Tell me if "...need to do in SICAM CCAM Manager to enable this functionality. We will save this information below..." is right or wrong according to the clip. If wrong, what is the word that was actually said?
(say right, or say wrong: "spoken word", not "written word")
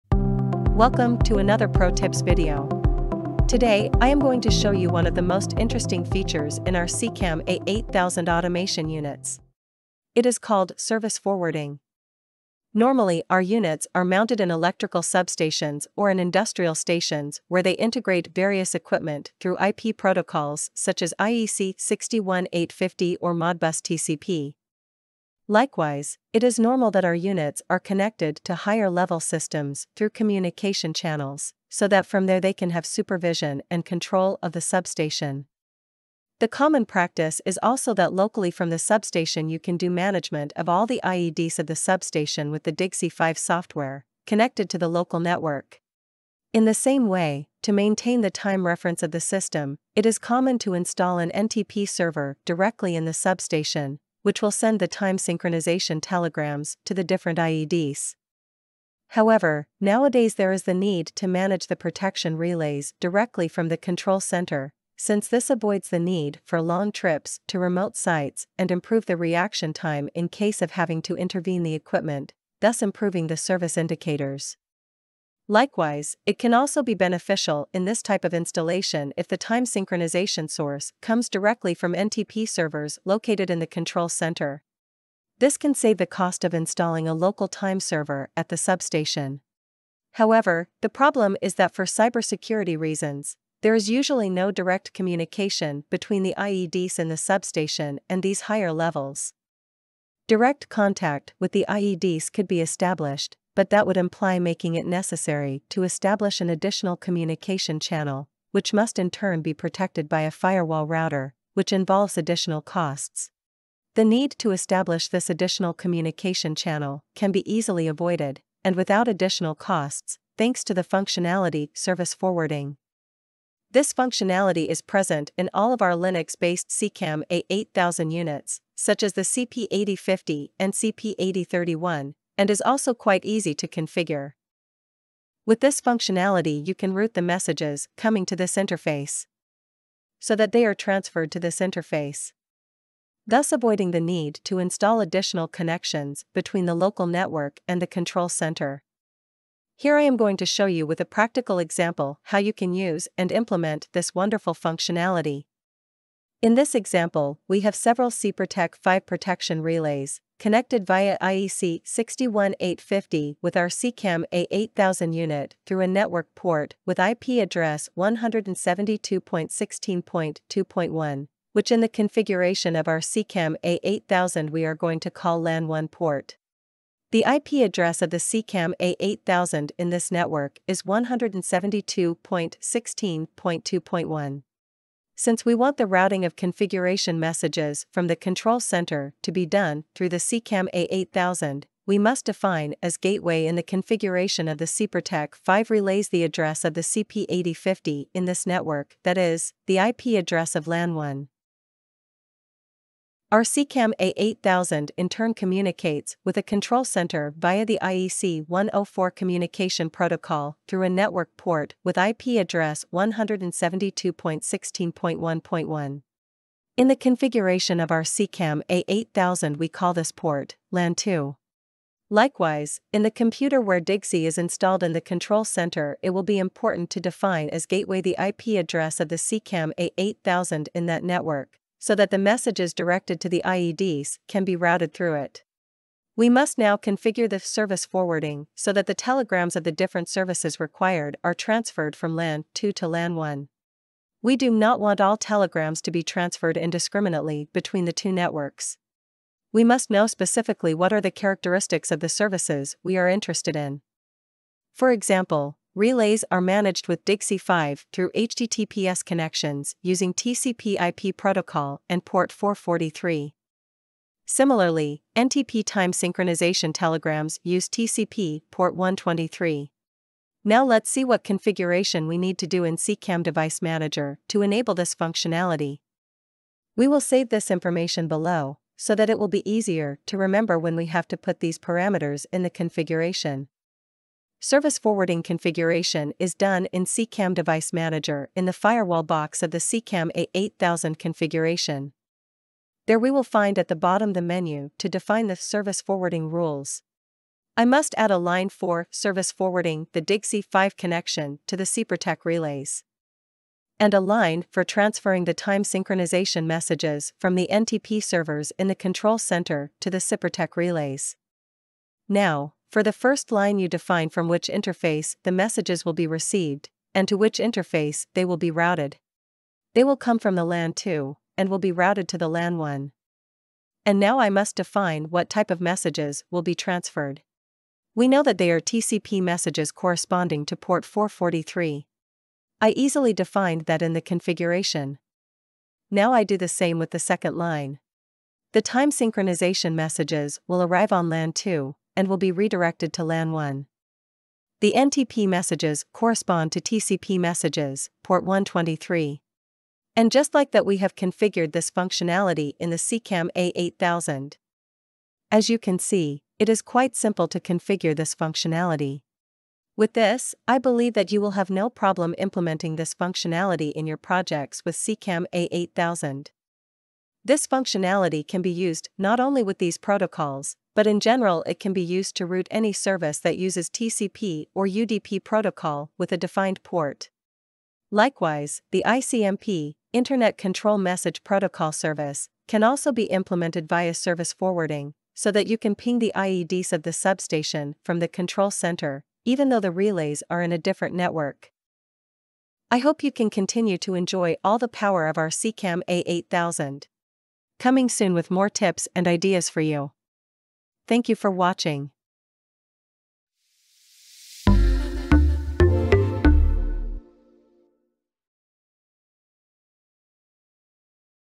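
wrong: "Device", not "CCAM".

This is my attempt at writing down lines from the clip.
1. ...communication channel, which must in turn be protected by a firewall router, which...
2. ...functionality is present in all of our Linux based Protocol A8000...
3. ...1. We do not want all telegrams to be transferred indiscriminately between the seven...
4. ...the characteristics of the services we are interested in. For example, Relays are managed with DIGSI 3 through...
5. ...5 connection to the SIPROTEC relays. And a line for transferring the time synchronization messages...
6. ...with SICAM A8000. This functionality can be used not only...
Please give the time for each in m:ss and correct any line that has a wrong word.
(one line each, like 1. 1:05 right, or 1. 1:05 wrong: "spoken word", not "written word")
1. 1:46 right
2. 2:03 wrong: "SICAM", not "Protocol"
3. 4:03 wrong: "two", not "seven"
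4. 4:11 wrong: "5", not "3"
5. 5:00 right
6. 6:04 right.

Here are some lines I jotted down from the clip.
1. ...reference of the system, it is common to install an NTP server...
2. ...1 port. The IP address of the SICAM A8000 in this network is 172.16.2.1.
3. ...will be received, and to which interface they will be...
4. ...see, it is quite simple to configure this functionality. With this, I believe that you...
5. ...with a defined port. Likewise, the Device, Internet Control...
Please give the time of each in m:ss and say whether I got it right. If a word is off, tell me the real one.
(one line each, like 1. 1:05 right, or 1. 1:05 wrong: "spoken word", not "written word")
1. 0:48 right
2. 2:55 right
3. 5:15 right
4. 5:55 right
5. 6:15 wrong: "ICMP", not "Device".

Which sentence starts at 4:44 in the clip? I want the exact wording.
Service forwarding configuration is done in SICAM Device Manager in the firewall box of the SICAM A8000 configuration.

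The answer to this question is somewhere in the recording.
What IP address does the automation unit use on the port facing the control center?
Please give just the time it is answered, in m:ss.
3:32.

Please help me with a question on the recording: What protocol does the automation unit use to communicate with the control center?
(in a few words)
IEC 104.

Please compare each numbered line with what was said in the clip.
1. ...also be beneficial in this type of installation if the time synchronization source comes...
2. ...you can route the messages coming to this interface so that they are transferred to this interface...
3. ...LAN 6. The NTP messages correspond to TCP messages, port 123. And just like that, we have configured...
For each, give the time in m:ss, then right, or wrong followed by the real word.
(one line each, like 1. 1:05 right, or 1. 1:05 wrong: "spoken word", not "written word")
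1. 1:16 right
2. 2:16 right
3. 5:43 wrong: "1", not "6".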